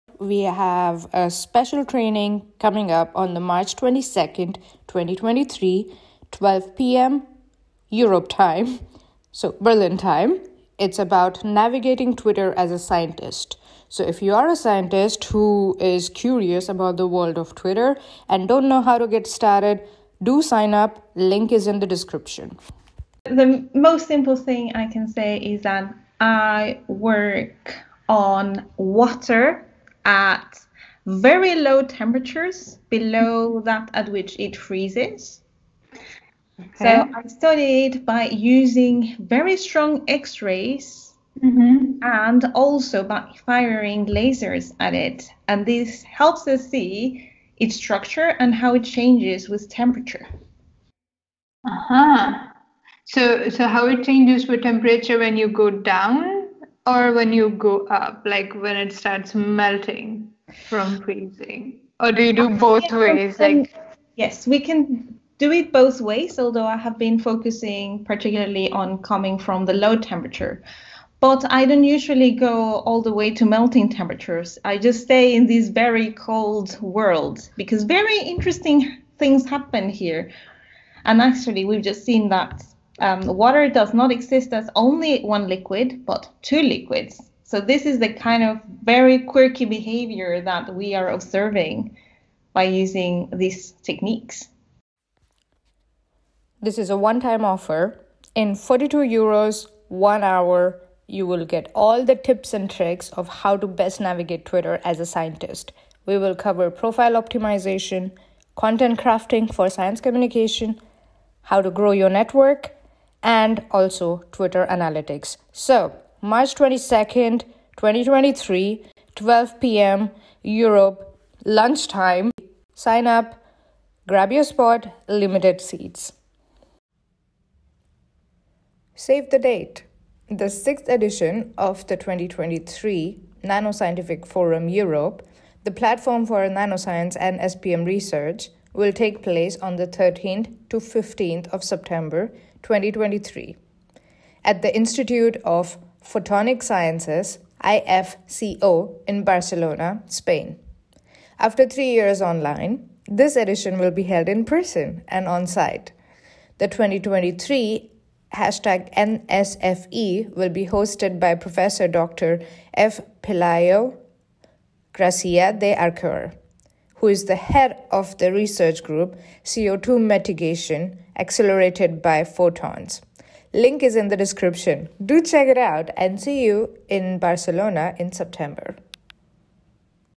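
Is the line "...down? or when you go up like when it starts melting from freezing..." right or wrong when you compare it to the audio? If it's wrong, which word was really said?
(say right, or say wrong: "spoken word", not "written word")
right.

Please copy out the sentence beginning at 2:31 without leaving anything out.
After three years online, this edition will be held in person and on site.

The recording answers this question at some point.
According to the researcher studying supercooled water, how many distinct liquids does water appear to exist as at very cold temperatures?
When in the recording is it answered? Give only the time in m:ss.
1:26.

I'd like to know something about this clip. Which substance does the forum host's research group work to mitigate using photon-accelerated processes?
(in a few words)
CO2.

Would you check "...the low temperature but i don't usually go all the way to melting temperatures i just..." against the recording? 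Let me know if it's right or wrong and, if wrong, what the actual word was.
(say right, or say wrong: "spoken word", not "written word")
right.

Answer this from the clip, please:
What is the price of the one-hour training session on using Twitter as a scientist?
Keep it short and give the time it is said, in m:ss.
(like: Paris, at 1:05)
42 euros, at 1:38.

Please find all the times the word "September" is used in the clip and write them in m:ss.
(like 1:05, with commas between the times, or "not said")
2:21, 2:58.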